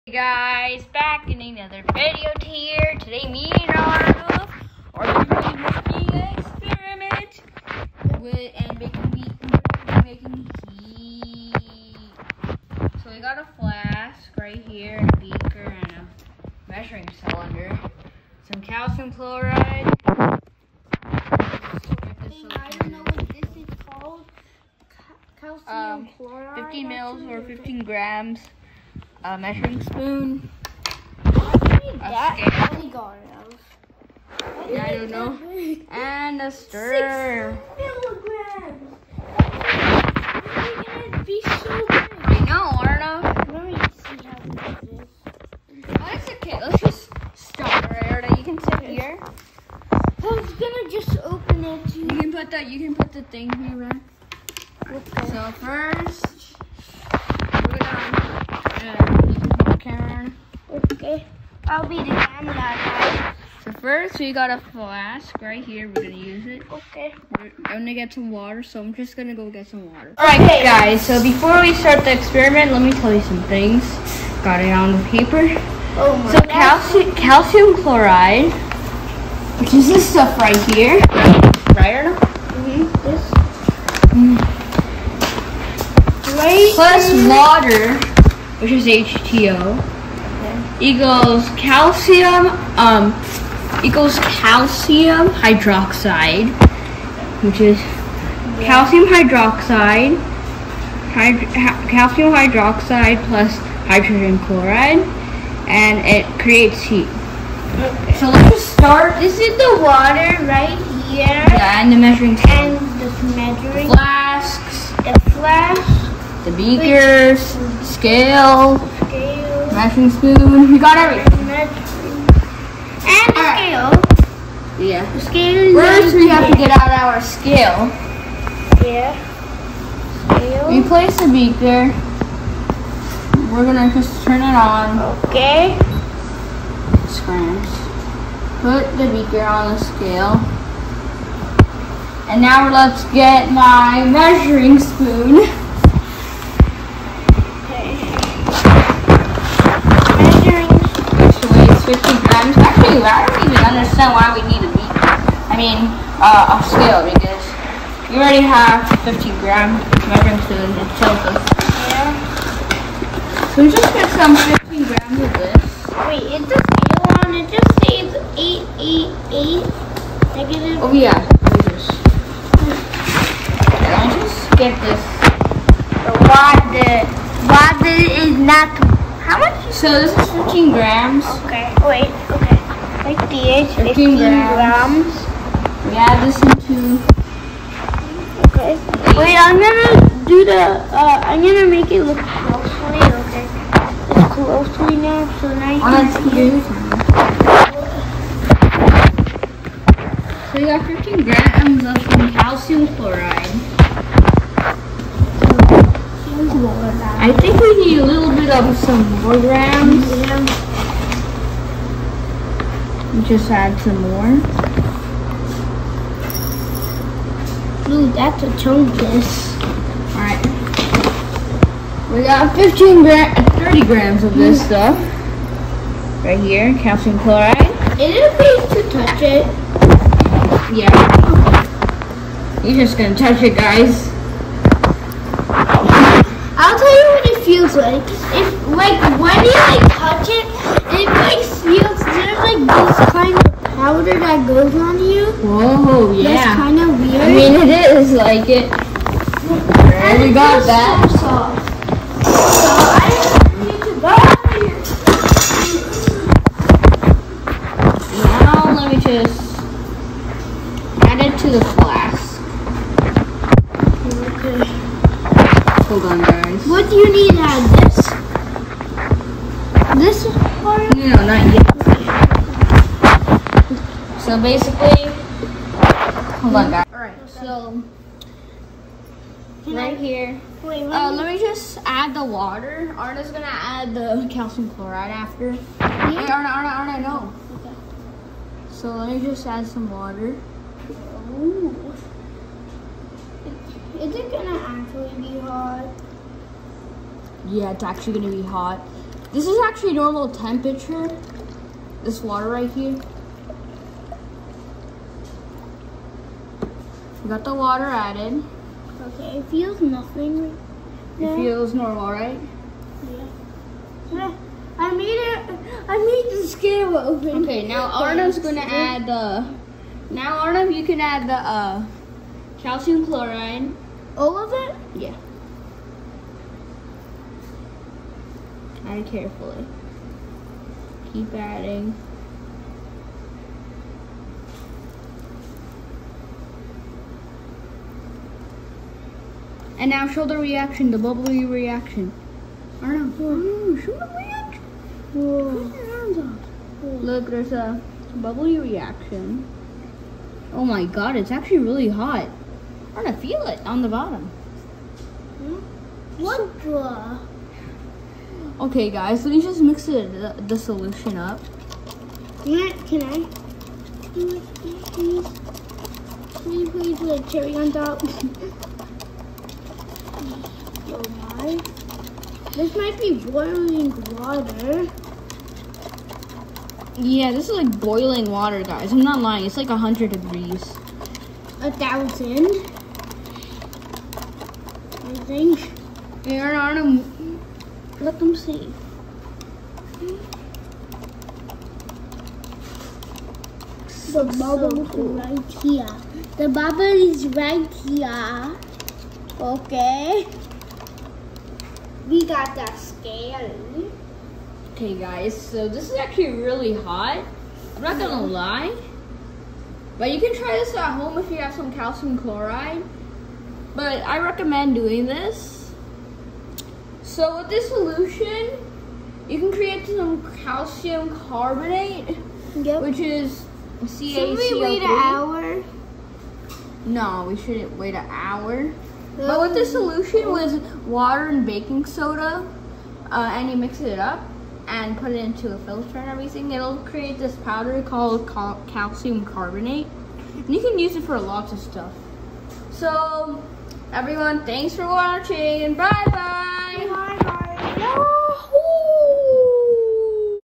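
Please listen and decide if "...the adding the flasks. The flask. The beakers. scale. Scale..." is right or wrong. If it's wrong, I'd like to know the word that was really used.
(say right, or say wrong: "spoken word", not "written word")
wrong: "measuring", not "adding".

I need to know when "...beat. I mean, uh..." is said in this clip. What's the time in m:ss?
2:34.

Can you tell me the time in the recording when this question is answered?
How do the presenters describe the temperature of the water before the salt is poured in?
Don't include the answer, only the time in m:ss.
4:59.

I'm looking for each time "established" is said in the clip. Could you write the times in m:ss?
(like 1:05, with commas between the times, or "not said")
not said.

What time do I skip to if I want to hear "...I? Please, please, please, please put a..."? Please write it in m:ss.
6:03.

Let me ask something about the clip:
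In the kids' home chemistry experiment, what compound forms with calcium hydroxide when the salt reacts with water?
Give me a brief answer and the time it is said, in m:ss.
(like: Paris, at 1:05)
hydrogen chloride, at 1:43.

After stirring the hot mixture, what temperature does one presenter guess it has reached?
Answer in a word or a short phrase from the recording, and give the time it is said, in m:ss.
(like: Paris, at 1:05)
100 degrees, at 6:19.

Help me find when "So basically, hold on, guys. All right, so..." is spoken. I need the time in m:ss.
4:34.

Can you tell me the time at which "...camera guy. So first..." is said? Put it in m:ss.
1:02.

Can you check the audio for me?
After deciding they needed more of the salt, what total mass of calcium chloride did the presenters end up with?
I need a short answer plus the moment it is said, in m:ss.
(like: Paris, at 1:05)
30 grams, at 3:43.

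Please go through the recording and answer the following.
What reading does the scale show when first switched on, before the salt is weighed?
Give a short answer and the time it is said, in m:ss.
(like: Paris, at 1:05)
888 negative, at 2:48.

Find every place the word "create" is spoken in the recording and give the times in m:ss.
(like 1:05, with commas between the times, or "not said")
1:46, 6:59, 7:16.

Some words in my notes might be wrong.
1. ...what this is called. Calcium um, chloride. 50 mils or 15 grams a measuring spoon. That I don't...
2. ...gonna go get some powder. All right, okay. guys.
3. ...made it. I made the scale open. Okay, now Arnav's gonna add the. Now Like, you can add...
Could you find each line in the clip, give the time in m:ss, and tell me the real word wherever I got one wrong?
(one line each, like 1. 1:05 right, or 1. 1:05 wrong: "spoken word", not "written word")
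1. 0:23 right
2. 1:09 wrong: "water", not "powder"
3. 5:14 wrong: "Arnav", not "Like".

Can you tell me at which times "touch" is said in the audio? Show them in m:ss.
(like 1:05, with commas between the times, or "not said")
3:48, 3:53, 3:59.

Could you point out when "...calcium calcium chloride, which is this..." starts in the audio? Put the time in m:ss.
1:16.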